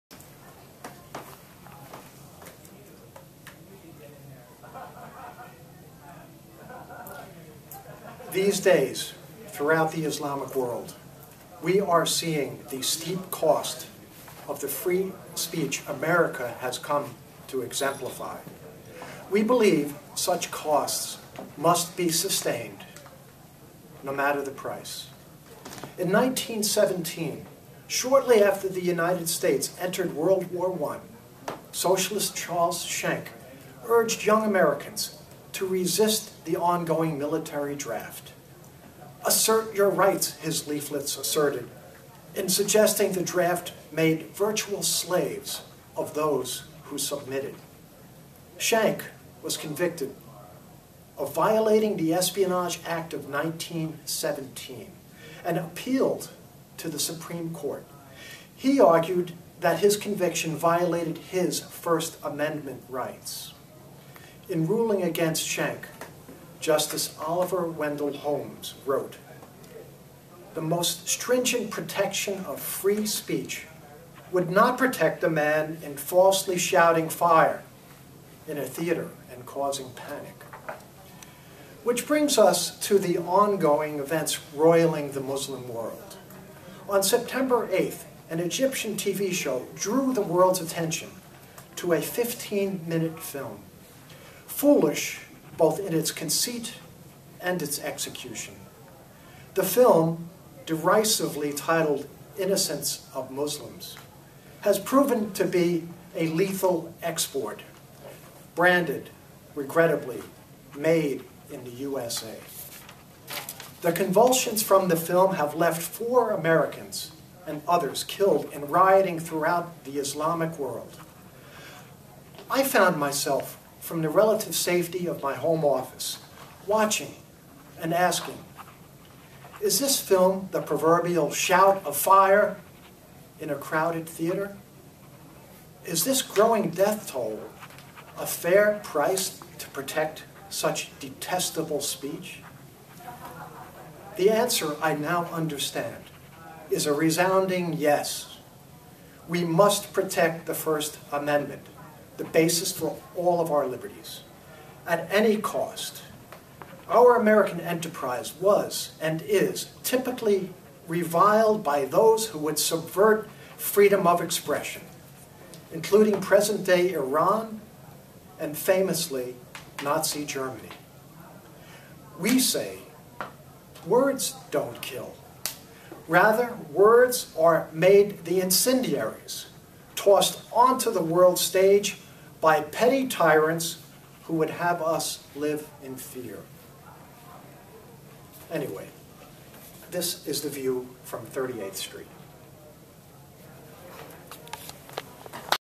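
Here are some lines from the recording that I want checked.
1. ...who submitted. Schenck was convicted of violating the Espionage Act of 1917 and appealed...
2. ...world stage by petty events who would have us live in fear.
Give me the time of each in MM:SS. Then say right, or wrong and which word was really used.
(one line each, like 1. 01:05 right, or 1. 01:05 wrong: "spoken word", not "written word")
1. 00:46 right
2. 03:01 wrong: "tyrants", not "events".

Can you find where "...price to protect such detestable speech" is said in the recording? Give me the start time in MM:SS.
02:18.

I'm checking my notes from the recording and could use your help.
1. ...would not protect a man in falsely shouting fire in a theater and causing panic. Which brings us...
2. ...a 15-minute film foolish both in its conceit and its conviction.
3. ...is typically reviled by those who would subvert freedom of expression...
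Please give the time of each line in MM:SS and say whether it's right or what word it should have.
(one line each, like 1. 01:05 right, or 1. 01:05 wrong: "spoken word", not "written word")
1. 01:14 right
2. 01:31 wrong: "execution", not "conviction"
3. 02:39 right.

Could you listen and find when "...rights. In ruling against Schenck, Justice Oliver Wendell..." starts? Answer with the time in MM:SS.
01:02.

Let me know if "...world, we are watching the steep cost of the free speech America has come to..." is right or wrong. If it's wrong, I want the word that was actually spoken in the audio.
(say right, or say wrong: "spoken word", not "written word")
wrong: "seeing", not "watching".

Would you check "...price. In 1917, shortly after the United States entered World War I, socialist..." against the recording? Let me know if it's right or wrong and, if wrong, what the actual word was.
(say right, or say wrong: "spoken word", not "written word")
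right.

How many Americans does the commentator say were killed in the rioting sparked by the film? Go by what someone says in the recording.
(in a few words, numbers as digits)
4.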